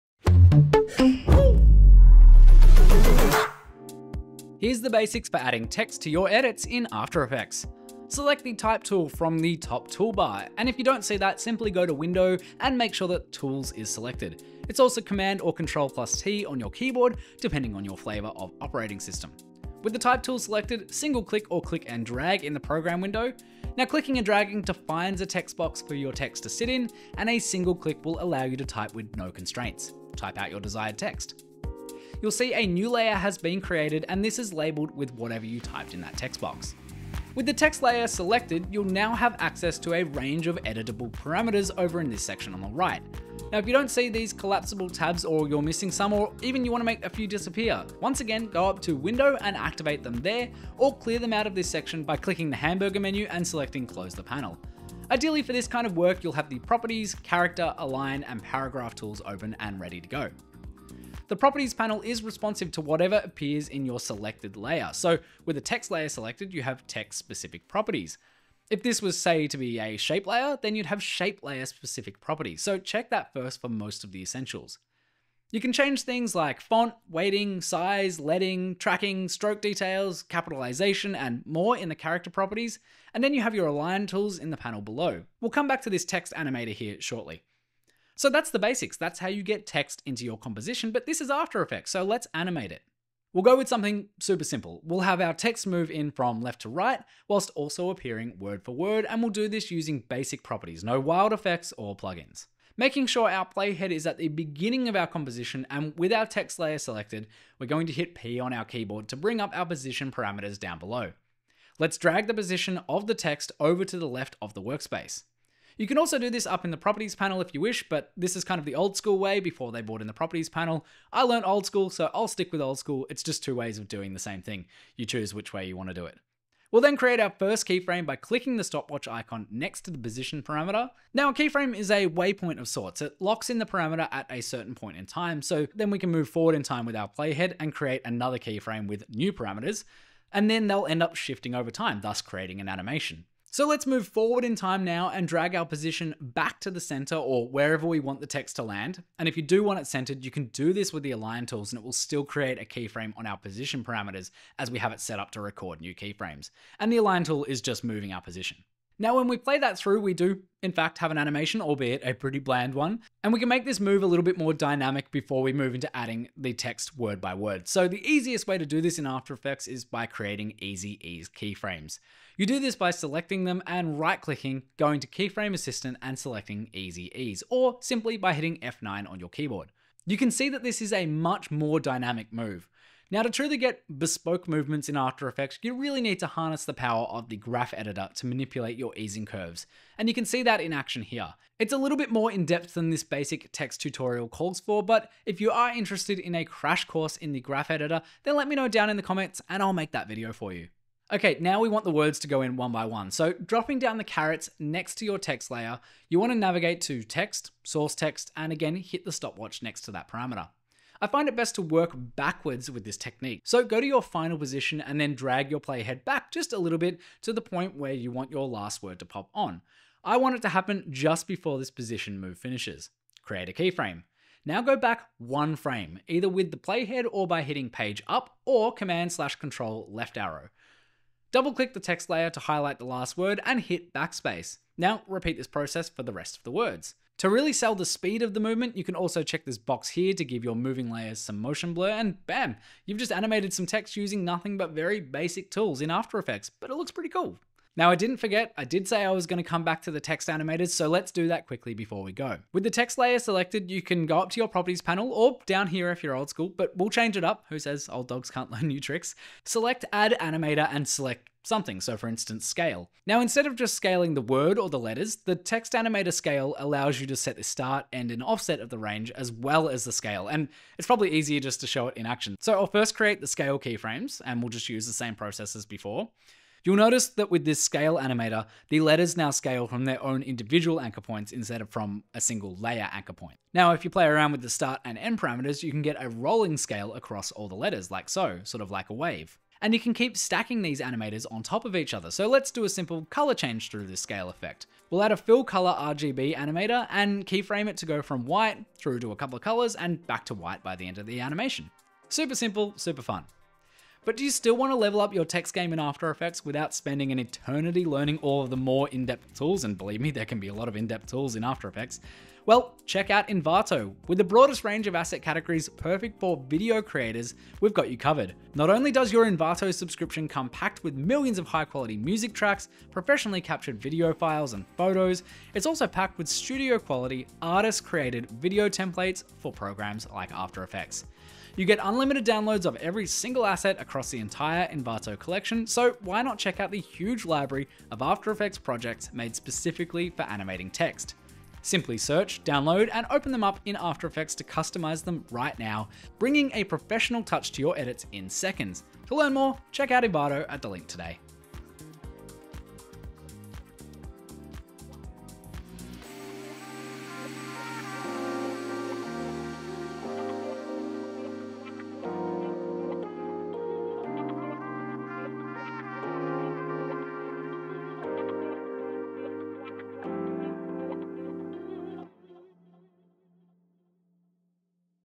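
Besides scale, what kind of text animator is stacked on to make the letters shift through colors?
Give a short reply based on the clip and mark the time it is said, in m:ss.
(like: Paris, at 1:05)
Fill color RGB, at 4:55.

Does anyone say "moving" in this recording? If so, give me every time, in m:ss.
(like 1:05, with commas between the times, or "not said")
2:37, 4:00.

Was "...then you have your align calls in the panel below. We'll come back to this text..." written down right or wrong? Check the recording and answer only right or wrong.
wrong.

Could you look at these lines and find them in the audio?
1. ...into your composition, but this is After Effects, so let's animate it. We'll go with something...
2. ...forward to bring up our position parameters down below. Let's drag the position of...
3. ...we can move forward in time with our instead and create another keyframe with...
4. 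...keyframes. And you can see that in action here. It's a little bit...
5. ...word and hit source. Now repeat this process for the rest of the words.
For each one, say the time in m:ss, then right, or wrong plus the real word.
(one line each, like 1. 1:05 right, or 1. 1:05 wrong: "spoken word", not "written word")
1. 1:30 right
2. 1:48 wrong: "keyboard", not "forward"
3. 2:15 wrong: "playhead", not "instead"
4. 3:09 wrong: "curves", not "keyframes"
5. 3:53 wrong: "backspace", not "source".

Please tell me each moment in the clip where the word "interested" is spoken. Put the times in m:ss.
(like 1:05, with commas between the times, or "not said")
3:15.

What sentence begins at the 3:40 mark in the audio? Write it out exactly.
I want it to happen just before this position move finishes.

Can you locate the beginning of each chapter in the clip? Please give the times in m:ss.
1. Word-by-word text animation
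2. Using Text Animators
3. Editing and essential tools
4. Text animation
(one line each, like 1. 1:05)
1. 3:21
2. 4:07
3. 0:55
4. 1:33.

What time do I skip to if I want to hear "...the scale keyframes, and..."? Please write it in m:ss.
4:33.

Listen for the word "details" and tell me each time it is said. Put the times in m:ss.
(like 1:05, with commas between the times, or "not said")
1:19.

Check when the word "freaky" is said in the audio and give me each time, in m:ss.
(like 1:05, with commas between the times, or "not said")
not said.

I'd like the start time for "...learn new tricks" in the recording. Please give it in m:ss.
4:18.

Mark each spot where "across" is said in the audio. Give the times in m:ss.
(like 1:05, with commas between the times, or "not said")
4:46, 5:33.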